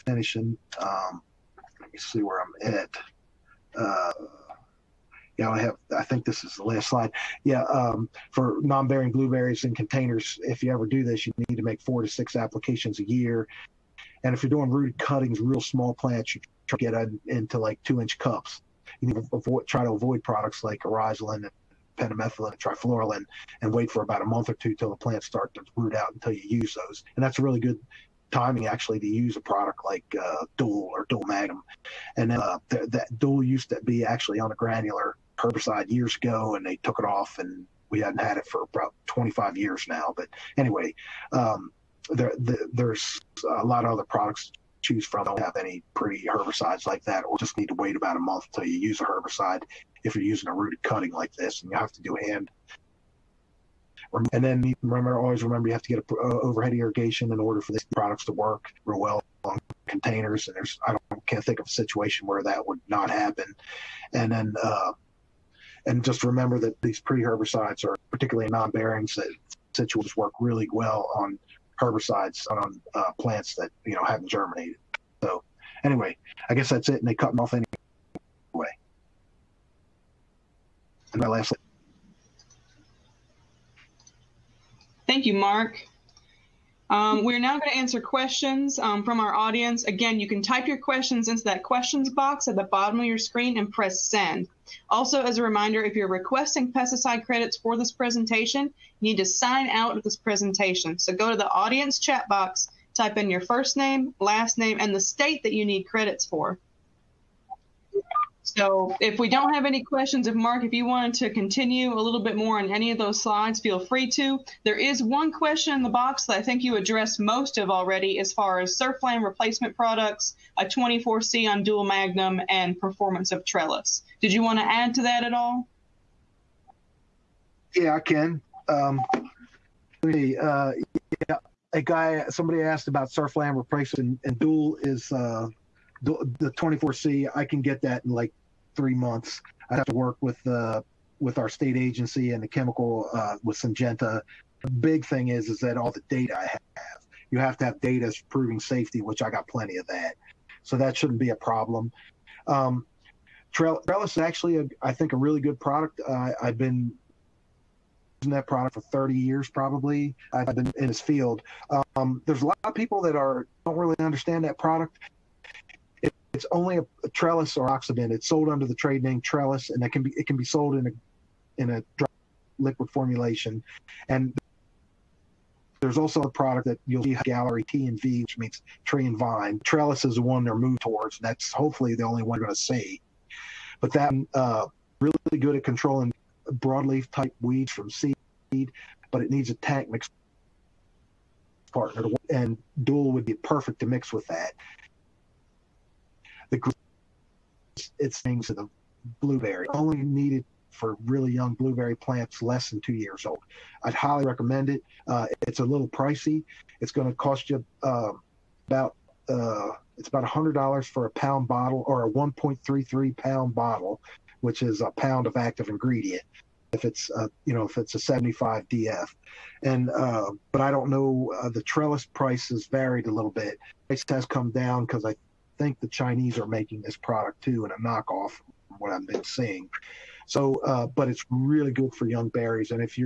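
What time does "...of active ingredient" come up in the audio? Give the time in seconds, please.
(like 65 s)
215 s.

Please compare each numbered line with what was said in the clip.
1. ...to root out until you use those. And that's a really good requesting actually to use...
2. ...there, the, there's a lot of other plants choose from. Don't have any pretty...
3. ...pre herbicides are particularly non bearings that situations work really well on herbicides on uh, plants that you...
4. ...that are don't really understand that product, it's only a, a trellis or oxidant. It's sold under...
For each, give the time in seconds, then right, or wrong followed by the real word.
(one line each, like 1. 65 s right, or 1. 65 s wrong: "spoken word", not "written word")
1. 25 s wrong: "timing", not "requesting"
2. 42 s wrong: "products", not "plants"
3. 67 s right
4. 163 s right.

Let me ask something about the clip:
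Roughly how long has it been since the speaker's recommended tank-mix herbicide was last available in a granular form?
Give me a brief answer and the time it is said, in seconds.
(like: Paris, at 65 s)
25 years, at 39 s.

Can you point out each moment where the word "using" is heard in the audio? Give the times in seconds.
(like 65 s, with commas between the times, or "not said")
50 s, 158 s.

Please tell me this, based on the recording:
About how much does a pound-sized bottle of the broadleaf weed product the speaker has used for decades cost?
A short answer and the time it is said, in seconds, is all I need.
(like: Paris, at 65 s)
$100, at 210 s.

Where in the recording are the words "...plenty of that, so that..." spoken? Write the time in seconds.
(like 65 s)
149 s.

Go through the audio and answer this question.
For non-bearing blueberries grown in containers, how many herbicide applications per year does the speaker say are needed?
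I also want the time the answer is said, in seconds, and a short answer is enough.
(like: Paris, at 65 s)
4 to 6, at 11 s.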